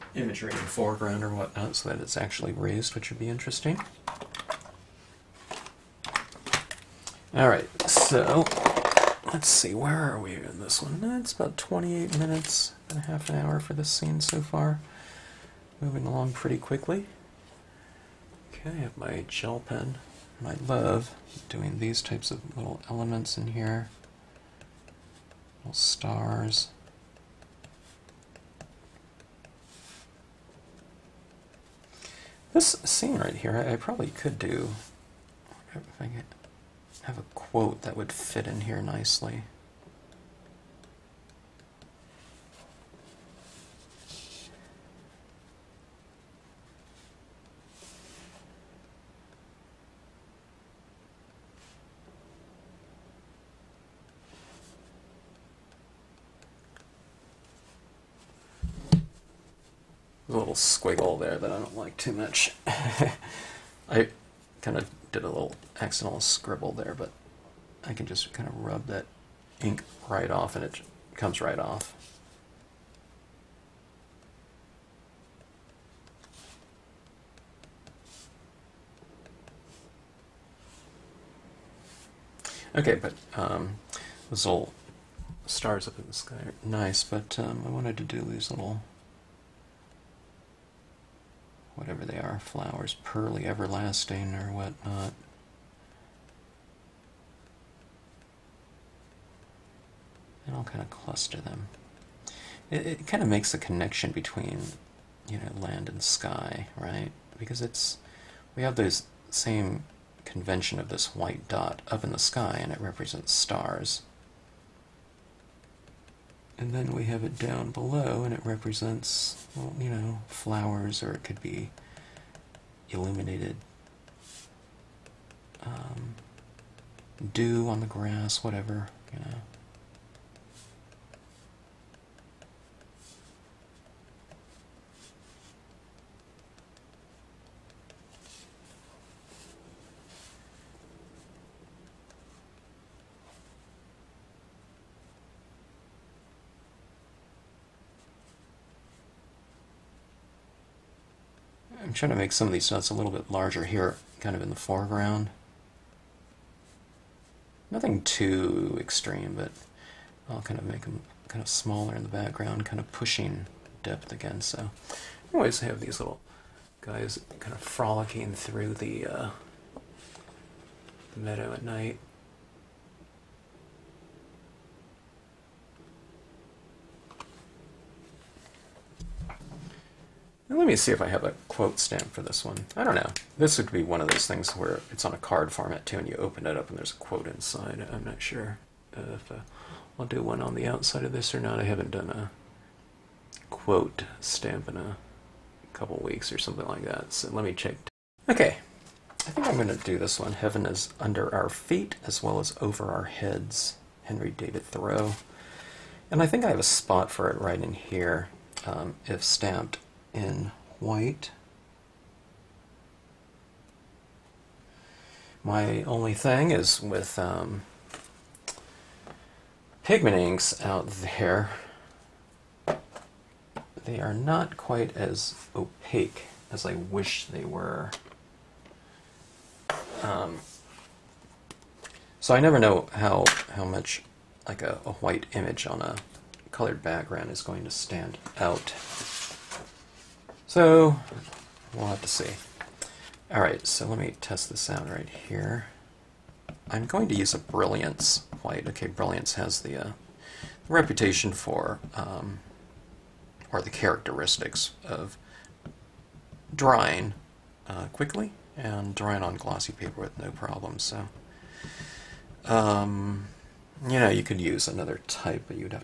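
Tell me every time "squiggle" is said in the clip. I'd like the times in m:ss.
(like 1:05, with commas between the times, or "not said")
1:00.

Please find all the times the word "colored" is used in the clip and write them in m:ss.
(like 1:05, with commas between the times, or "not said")
3:56.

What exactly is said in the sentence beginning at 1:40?
And I'll kind of cluster them.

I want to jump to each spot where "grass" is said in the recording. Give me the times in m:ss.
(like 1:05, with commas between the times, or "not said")
2:07.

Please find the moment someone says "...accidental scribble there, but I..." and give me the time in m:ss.
1:05.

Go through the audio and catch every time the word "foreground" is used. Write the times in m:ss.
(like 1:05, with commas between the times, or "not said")
0:00, 2:34.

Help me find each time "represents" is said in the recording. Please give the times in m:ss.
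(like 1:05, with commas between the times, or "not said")
1:52, 1:58.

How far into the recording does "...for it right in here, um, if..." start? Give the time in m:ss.
3:27.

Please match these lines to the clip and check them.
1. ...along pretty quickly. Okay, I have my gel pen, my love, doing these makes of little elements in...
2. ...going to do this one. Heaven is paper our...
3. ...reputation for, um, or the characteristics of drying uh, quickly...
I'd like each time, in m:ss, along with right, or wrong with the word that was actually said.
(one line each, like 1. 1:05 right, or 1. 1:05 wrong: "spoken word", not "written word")
1. 0:16 wrong: "types", not "makes"
2. 3:19 wrong: "under", not "paper"
3. 4:10 right.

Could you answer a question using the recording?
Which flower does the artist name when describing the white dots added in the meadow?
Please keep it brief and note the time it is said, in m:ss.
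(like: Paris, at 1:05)
Pearly everlasting, at 1:33.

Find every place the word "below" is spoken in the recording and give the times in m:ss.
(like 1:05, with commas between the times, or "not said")
1:57.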